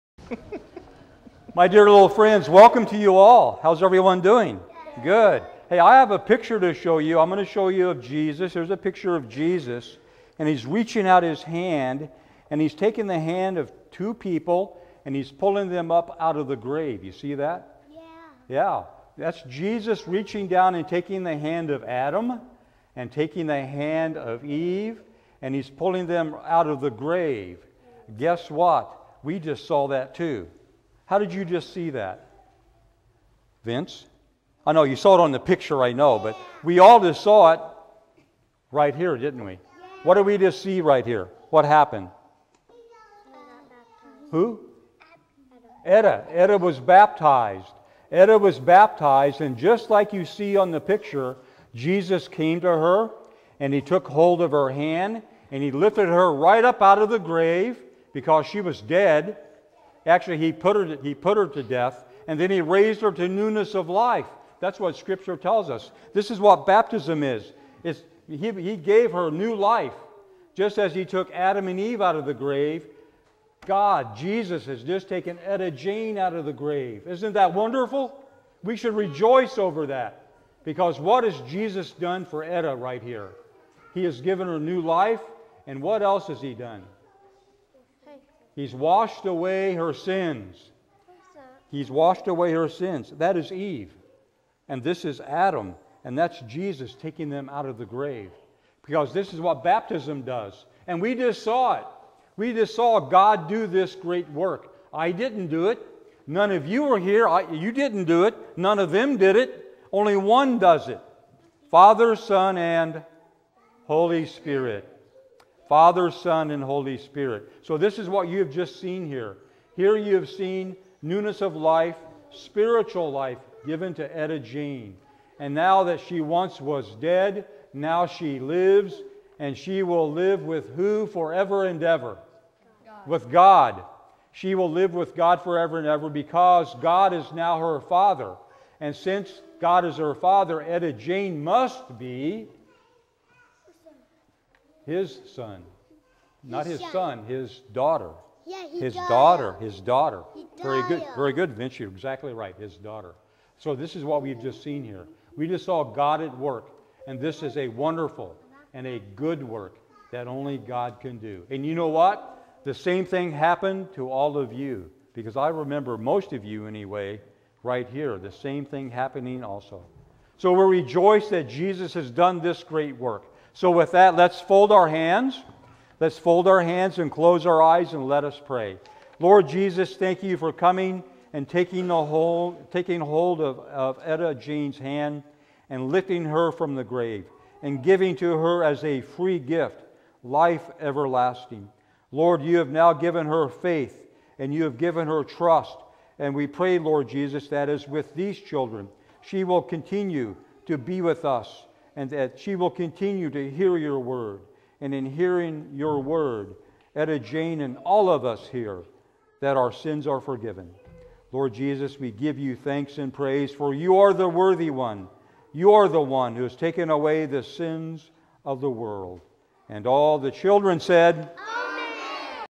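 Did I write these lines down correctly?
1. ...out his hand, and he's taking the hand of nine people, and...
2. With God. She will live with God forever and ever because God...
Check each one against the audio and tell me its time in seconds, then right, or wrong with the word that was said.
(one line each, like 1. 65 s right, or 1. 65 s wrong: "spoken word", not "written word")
1. 11 s wrong: "two", not "nine"
2. 133 s right.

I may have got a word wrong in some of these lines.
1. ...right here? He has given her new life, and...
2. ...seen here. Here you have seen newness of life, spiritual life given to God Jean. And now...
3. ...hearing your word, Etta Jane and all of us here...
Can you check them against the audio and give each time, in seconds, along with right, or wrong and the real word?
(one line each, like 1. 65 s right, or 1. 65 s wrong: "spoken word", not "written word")
1. 82 s right
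2. 118 s wrong: "Etta", not "God"
3. 205 s right.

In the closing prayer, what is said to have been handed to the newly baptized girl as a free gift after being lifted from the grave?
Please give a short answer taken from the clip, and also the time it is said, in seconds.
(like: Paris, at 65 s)
Life everlasting, at 190 s.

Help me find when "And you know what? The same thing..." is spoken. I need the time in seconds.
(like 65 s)
161 s.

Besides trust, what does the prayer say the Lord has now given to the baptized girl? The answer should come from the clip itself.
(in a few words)
Faith.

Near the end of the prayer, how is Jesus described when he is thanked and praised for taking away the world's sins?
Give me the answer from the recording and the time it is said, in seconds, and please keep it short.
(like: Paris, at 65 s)
The worthy one, at 214 s.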